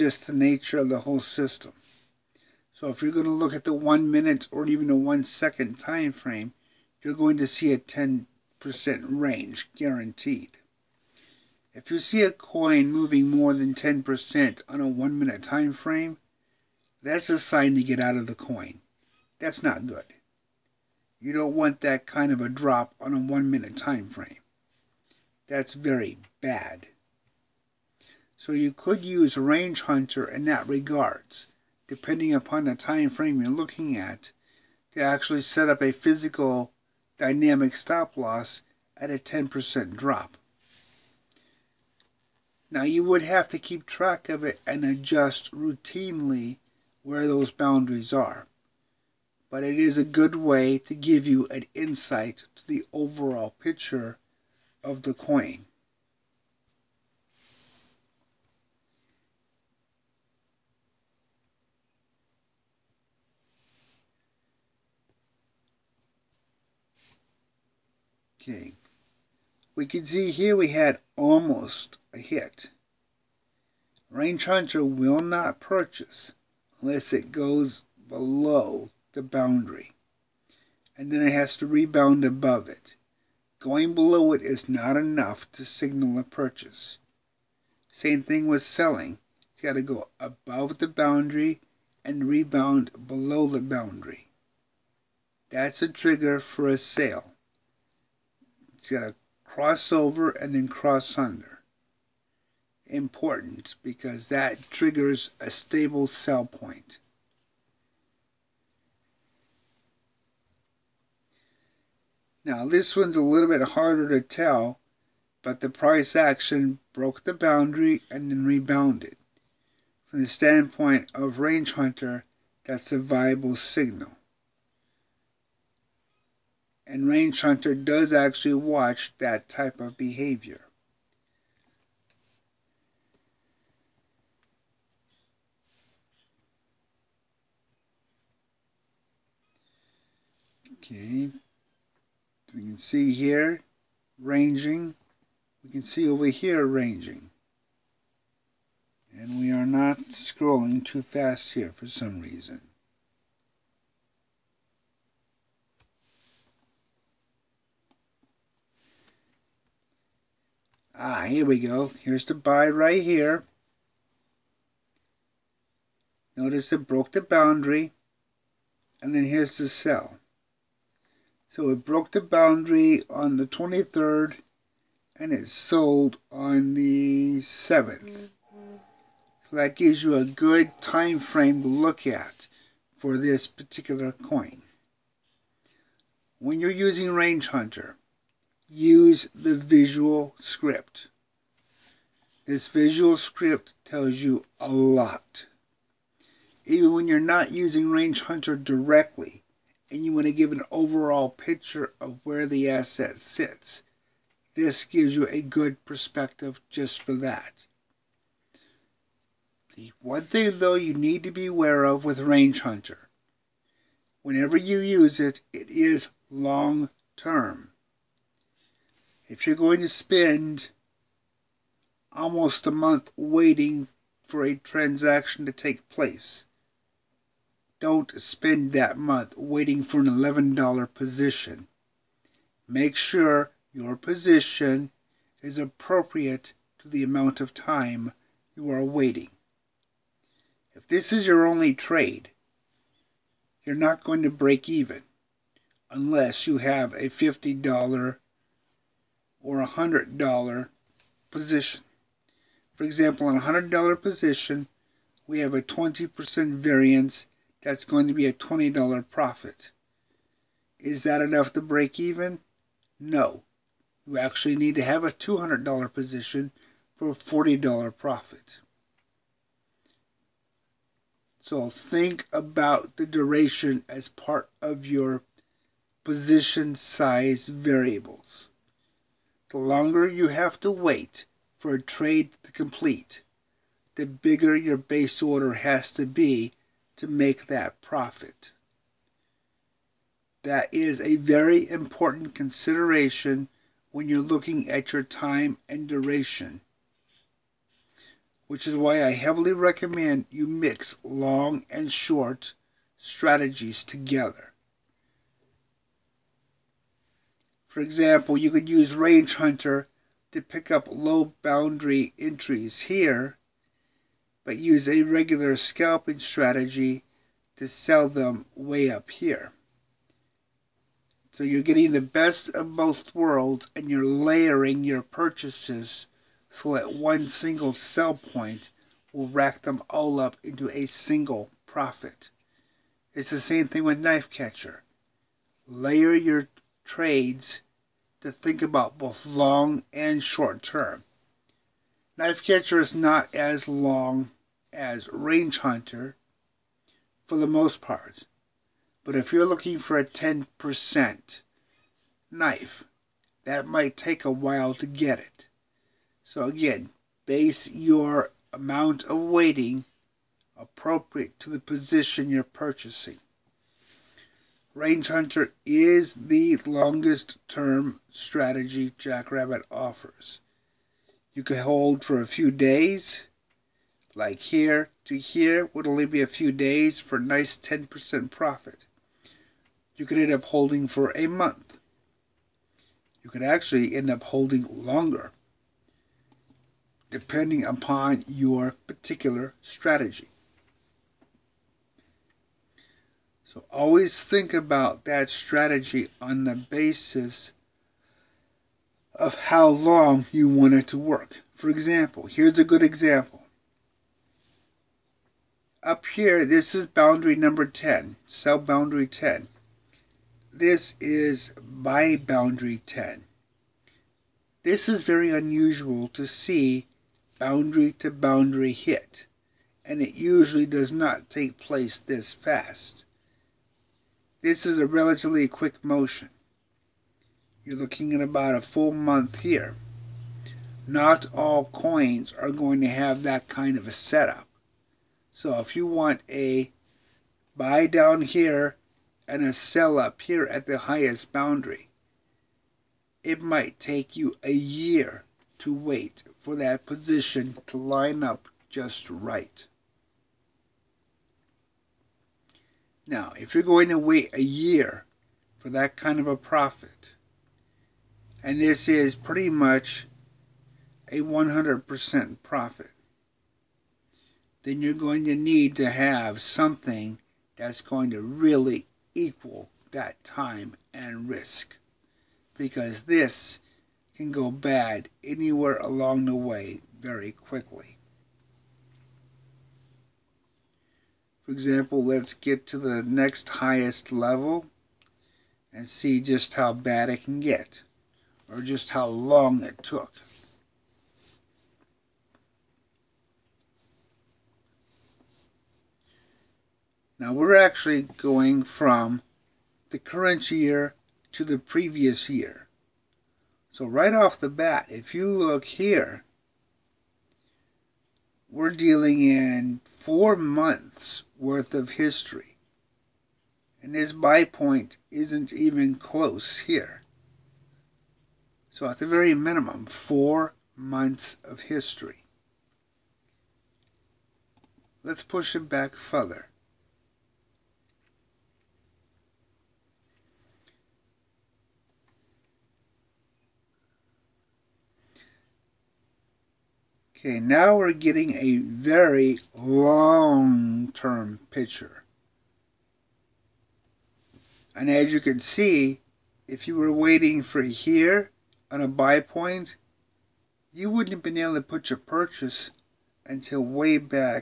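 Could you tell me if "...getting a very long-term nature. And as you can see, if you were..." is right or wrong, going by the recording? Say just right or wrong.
wrong.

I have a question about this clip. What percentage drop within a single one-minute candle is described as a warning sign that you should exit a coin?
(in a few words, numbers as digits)
10%.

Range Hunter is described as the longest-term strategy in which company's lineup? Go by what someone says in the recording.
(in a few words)
Jackrabbit.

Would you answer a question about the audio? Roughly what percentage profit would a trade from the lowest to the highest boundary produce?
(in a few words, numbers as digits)
100%.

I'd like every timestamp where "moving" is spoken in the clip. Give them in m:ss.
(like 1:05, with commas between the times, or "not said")
0:12.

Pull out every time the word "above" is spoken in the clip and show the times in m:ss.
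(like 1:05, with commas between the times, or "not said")
1:22, 1:30.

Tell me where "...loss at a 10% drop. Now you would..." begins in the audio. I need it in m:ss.
0:38.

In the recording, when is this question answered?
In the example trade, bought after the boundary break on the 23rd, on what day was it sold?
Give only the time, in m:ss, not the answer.
2:56.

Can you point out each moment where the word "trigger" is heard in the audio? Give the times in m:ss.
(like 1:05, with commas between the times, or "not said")
1:35, 1:44.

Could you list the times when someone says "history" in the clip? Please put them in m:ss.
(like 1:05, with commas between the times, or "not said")
8:31, 8:41.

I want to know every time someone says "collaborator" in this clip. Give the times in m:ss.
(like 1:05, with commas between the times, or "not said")
not said.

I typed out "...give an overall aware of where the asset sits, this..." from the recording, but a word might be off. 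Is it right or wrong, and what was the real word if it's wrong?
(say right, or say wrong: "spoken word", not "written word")
wrong: "picture", not "aware".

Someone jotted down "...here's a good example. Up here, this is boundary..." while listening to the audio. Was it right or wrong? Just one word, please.
right.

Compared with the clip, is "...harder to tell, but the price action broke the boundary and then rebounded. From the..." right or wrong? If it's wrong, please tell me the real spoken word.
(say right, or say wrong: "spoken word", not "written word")
right.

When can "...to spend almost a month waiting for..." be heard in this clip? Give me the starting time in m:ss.
3:39.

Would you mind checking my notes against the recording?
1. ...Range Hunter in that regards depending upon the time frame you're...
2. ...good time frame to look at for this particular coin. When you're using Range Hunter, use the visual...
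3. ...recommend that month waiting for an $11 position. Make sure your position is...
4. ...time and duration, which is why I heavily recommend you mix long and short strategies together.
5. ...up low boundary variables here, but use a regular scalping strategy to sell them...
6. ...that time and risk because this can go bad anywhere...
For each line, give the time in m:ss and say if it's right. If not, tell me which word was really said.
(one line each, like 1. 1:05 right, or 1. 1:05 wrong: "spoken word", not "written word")
1. 0:29 right
2. 3:00 right
3. 3:48 wrong: "spend", not "recommend"
4. 4:55 right
5. 5:10 wrong: "entries", not "variables"
6. 7:49 right.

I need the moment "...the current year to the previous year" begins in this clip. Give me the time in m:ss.
8:19.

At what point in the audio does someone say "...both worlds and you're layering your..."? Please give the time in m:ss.
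5:22.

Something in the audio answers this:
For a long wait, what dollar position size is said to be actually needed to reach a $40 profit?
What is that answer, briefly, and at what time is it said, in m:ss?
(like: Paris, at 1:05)
$200, at 4:25.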